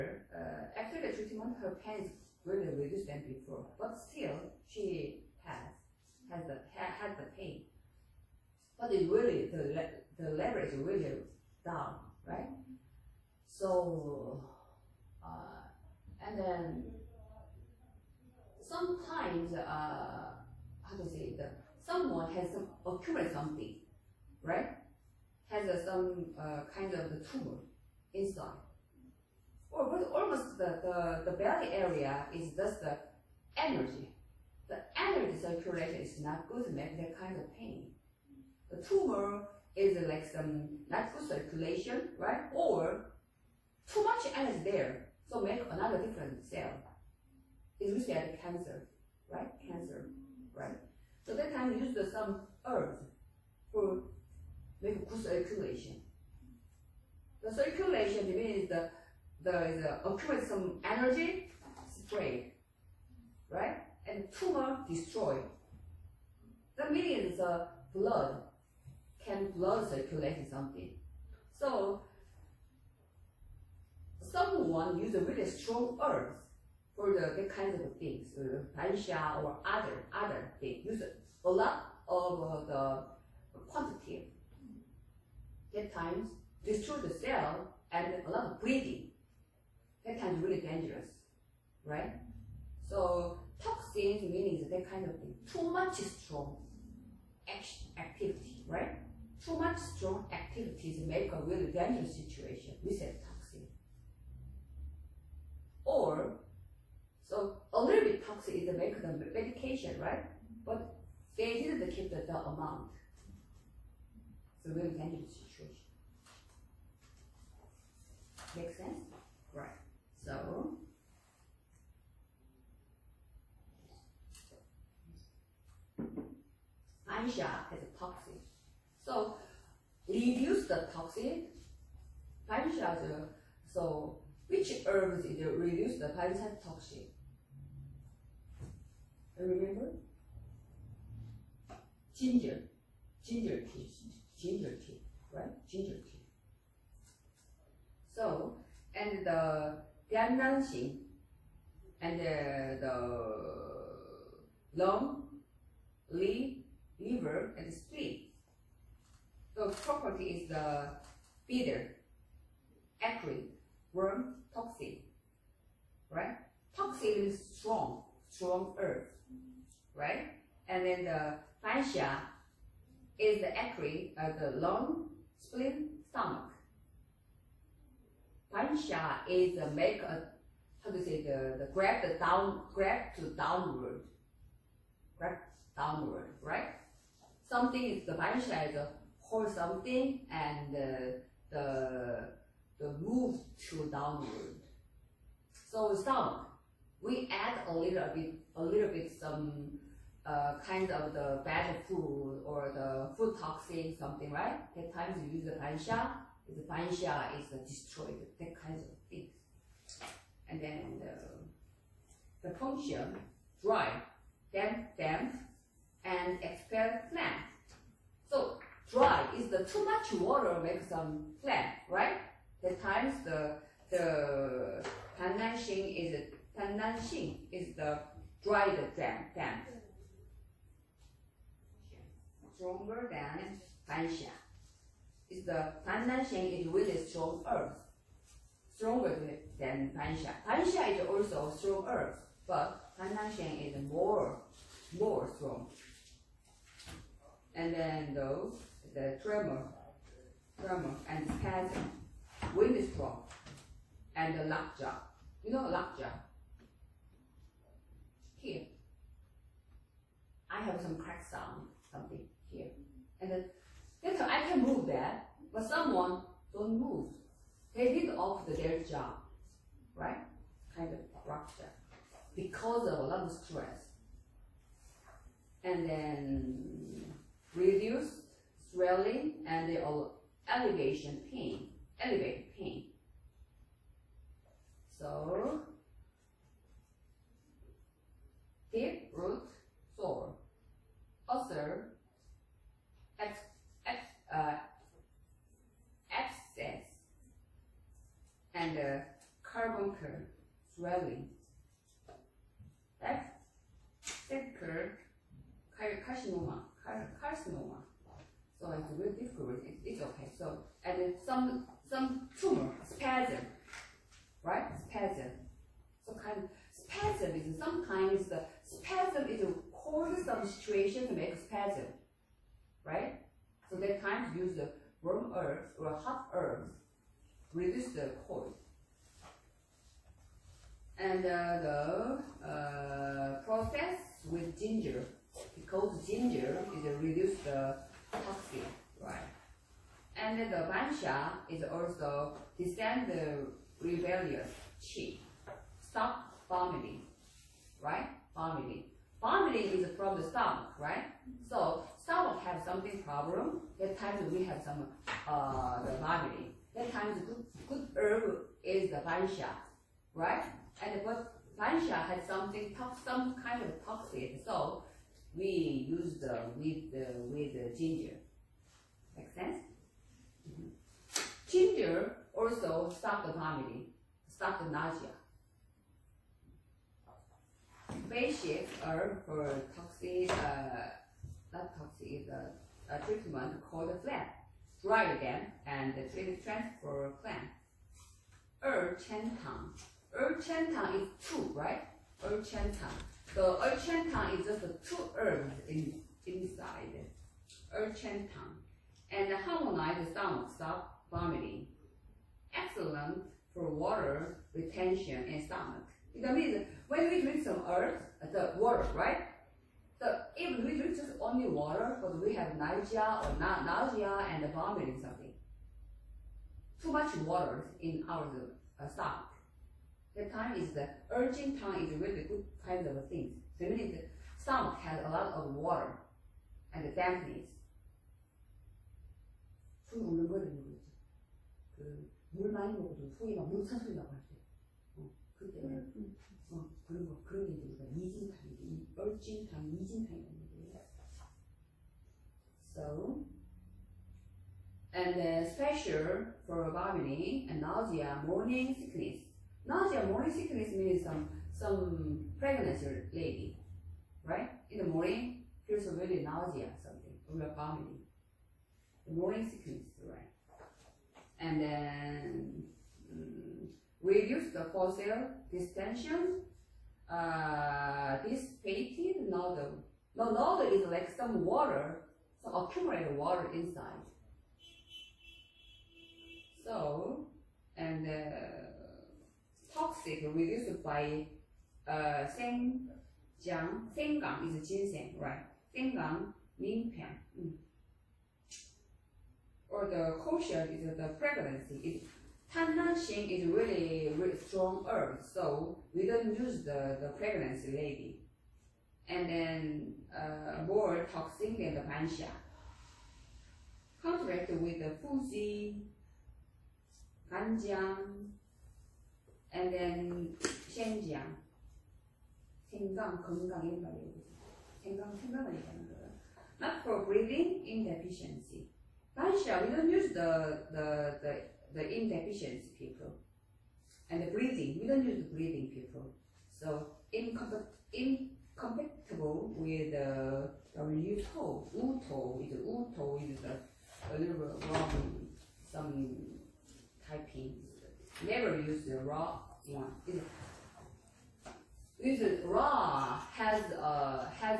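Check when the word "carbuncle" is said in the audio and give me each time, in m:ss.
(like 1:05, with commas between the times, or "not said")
4:59.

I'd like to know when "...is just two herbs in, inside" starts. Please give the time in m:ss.
6:34.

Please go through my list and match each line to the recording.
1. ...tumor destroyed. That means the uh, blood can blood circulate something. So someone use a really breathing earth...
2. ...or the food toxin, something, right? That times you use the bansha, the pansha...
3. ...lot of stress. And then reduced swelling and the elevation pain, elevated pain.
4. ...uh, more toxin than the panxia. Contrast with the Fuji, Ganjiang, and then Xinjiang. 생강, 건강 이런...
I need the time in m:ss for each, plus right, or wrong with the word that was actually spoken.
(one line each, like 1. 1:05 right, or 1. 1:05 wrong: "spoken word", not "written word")
1. 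1:04 wrong: "strong", not "breathing"
2. 3:22 wrong: "bansha", not "pansha"
3. 4:33 right
4. 8:20 right.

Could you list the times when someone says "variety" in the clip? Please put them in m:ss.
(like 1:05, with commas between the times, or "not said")
not said.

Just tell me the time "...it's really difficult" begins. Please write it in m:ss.
5:08.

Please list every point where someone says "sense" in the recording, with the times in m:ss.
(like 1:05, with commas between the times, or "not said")
1:58, 6:09.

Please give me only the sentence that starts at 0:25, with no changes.
has uh, some uh, kind of tumor inside.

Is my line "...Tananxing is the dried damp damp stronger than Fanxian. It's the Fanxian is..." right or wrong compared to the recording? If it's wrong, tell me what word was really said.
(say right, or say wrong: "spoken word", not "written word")
right.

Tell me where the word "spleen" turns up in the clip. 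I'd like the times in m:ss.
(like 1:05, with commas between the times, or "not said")
2:37, 2:55.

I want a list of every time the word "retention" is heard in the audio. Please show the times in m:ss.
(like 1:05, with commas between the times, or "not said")
6:44.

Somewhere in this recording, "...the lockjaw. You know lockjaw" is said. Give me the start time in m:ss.
4:14.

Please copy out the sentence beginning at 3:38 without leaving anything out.
So dry is the too much water makes some phlegm, right?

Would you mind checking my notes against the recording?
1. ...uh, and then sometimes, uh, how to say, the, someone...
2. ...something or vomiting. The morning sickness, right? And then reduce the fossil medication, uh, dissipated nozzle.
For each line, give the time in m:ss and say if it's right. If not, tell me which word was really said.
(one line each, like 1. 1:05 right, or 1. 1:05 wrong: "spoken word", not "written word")
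1. 0:15 right
2. 7:36 wrong: "distension", not "medication".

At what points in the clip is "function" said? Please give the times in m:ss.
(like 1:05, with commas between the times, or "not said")
3:32.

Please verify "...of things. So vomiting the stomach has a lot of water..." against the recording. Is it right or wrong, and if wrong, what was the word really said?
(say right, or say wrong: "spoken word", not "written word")
wrong: "meaning", not "vomiting".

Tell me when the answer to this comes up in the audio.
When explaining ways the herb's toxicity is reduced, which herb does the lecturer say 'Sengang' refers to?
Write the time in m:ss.
8:04.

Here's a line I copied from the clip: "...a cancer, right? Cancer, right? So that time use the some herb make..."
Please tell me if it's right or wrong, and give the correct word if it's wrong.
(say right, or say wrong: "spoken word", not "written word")
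right.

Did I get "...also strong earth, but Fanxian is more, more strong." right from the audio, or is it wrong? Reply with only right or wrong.
right.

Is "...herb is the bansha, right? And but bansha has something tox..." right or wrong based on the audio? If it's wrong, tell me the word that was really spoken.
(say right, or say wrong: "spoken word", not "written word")
right.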